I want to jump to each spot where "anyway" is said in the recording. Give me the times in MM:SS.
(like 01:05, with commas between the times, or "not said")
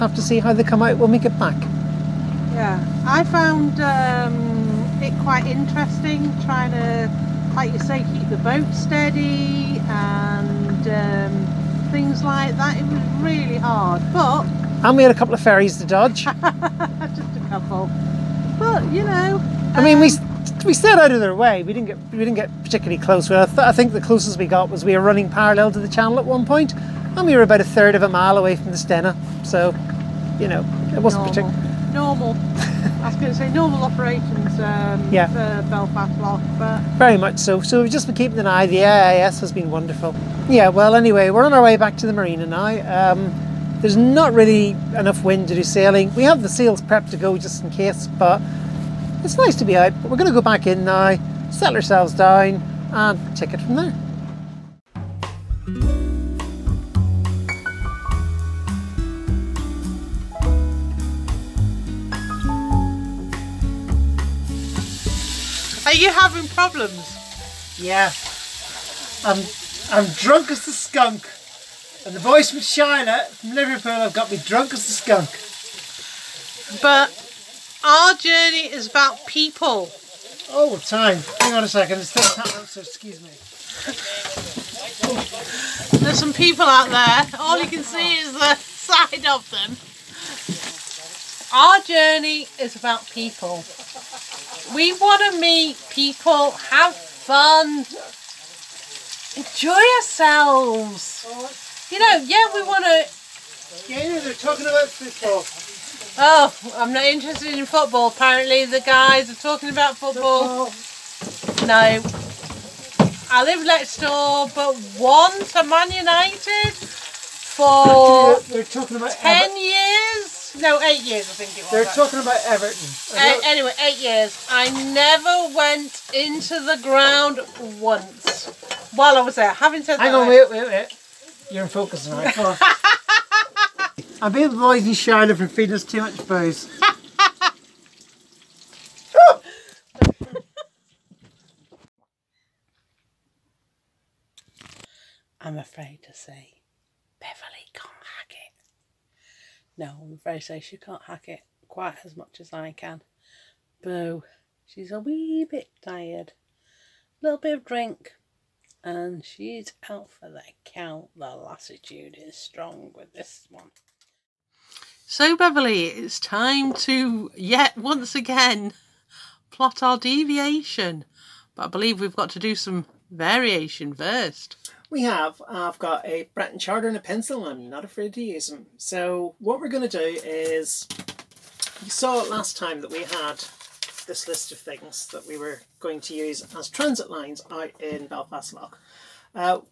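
00:40, 02:03.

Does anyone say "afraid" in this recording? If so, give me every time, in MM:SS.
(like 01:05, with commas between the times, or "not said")
02:25, 02:30, 02:57.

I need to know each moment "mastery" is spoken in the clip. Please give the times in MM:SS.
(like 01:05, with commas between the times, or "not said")
not said.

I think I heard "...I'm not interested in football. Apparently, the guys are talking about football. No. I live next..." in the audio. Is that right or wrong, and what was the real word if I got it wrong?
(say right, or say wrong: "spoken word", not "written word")
right.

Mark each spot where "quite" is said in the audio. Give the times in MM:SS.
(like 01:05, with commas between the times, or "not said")
00:05, 02:31.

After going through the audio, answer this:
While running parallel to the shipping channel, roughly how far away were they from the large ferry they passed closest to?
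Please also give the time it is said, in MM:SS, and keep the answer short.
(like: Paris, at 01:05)
a third of a mile, at 00:27.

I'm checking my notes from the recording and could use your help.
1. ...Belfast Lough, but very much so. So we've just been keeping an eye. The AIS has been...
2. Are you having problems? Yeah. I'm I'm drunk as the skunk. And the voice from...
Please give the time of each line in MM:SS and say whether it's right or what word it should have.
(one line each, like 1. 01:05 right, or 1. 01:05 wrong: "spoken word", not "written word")
1. 00:35 right
2. 01:05 right.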